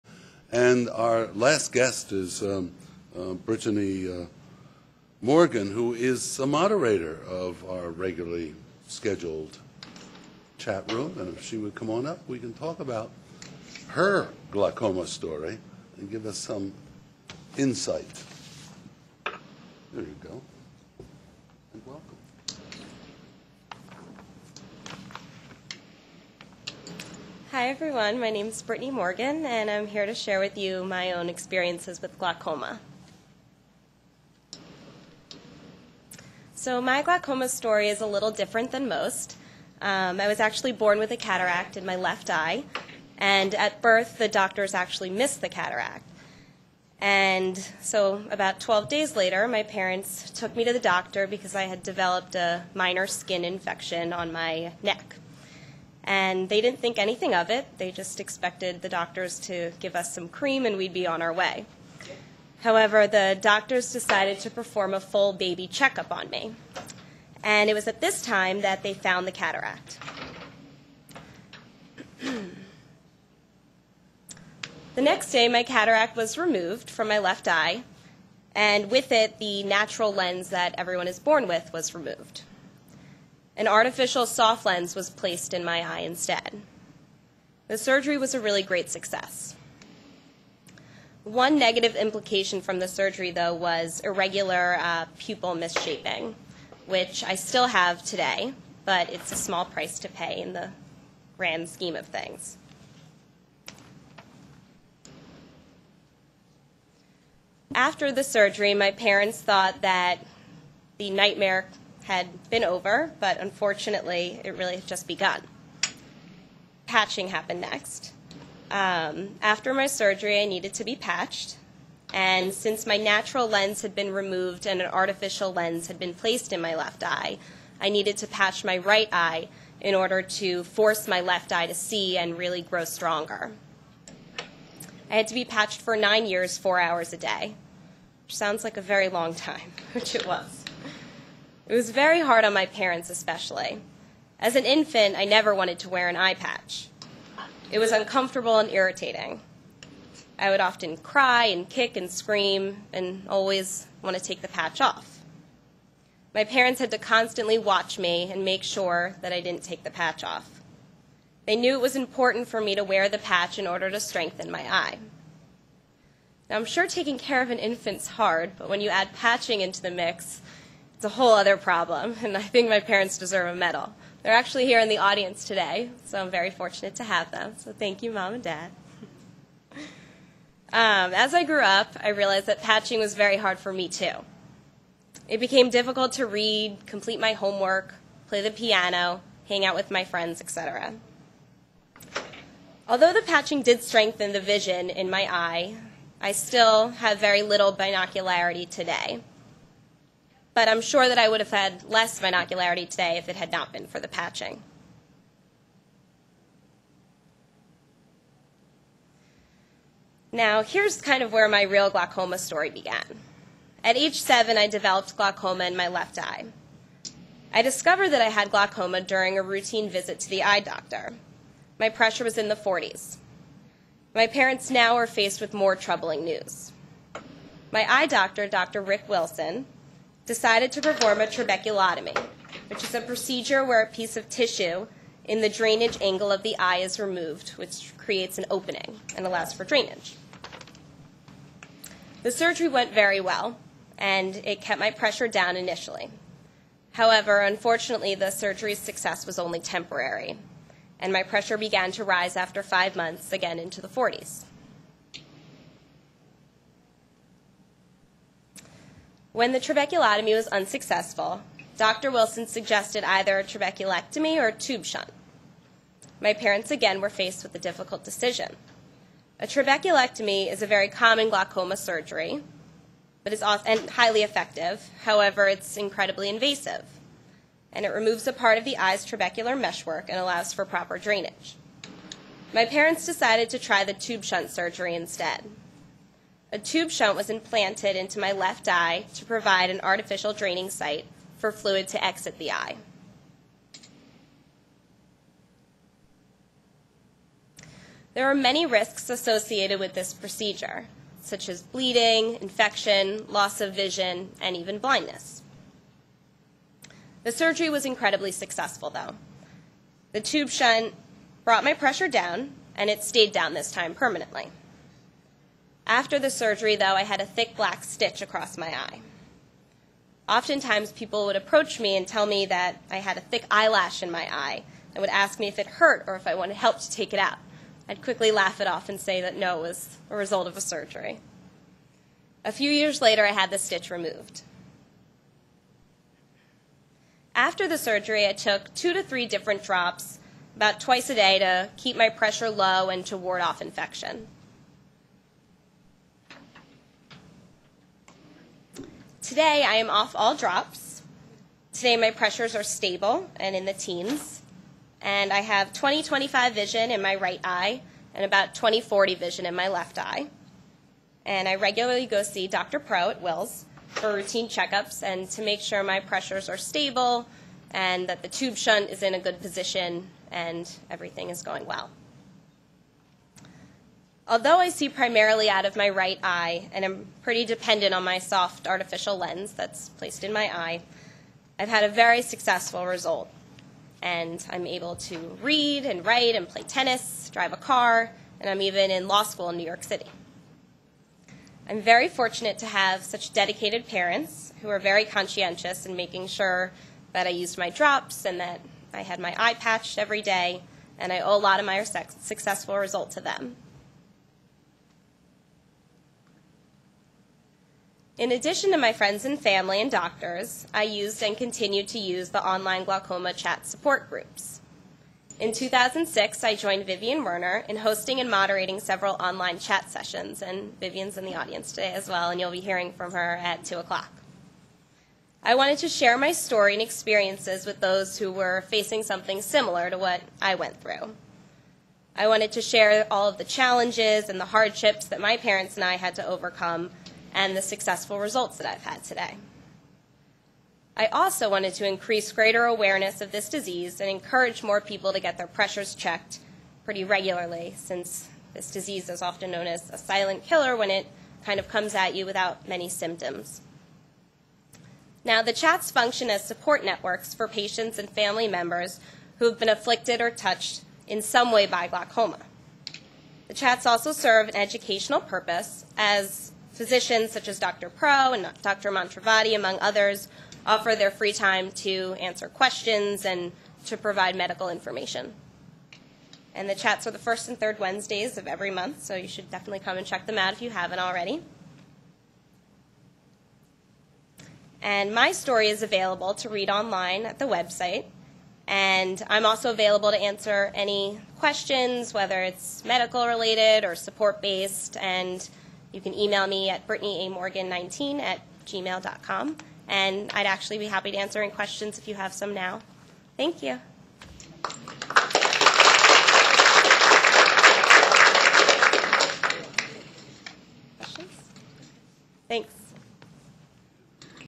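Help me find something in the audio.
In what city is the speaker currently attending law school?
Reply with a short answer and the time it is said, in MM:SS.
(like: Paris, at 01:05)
New York City, at 06:29.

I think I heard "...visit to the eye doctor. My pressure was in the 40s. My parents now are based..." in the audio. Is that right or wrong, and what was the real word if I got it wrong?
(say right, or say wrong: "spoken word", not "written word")
wrong: "faced", not "based".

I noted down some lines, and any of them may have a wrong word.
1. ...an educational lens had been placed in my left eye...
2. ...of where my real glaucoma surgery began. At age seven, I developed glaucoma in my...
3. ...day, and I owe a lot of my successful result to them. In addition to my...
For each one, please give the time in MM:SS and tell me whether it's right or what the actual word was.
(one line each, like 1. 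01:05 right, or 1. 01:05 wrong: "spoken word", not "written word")
1. 02:04 wrong: "artificial", not "educational"
2. 03:31 wrong: "story", not "surgery"
3. 06:40 right.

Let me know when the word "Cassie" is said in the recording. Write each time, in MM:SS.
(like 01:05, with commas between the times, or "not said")
not said.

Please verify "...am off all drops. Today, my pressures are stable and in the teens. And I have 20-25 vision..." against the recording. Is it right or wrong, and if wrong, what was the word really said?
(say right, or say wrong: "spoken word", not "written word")
right.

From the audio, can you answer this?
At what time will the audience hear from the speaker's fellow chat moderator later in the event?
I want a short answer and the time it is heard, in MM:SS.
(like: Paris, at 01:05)
2 o'clock, at 07:03.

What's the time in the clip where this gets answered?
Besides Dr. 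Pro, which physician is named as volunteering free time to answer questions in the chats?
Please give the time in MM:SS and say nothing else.
07:48.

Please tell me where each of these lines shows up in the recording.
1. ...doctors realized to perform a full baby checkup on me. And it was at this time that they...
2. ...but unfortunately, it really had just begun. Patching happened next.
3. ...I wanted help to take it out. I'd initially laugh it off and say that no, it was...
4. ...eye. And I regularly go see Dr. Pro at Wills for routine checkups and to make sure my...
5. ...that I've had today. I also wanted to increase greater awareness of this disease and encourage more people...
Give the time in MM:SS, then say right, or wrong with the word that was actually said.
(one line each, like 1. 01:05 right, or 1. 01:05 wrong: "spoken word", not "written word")
1. 01:03 wrong: "decided", not "realized"
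2. 01:53 right
3. 05:26 wrong: "quickly", not "initially"
4. 05:59 right
5. 07:18 right.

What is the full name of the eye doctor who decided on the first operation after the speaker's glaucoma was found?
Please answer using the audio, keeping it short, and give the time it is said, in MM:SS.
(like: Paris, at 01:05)
Rick Wilson, at 03:48.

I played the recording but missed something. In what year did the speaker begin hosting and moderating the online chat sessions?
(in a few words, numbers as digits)
2006.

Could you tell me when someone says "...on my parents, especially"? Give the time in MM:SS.
02:22.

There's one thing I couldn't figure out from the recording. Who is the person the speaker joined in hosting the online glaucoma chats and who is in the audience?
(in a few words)
Vivian Werner.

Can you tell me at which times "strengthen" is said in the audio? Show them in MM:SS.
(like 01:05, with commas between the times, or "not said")
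02:44, 03:13.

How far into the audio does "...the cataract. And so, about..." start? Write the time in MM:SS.
00:45.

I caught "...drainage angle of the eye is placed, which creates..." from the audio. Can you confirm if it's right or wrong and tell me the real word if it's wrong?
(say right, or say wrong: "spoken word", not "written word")
wrong: "removed", not "placed".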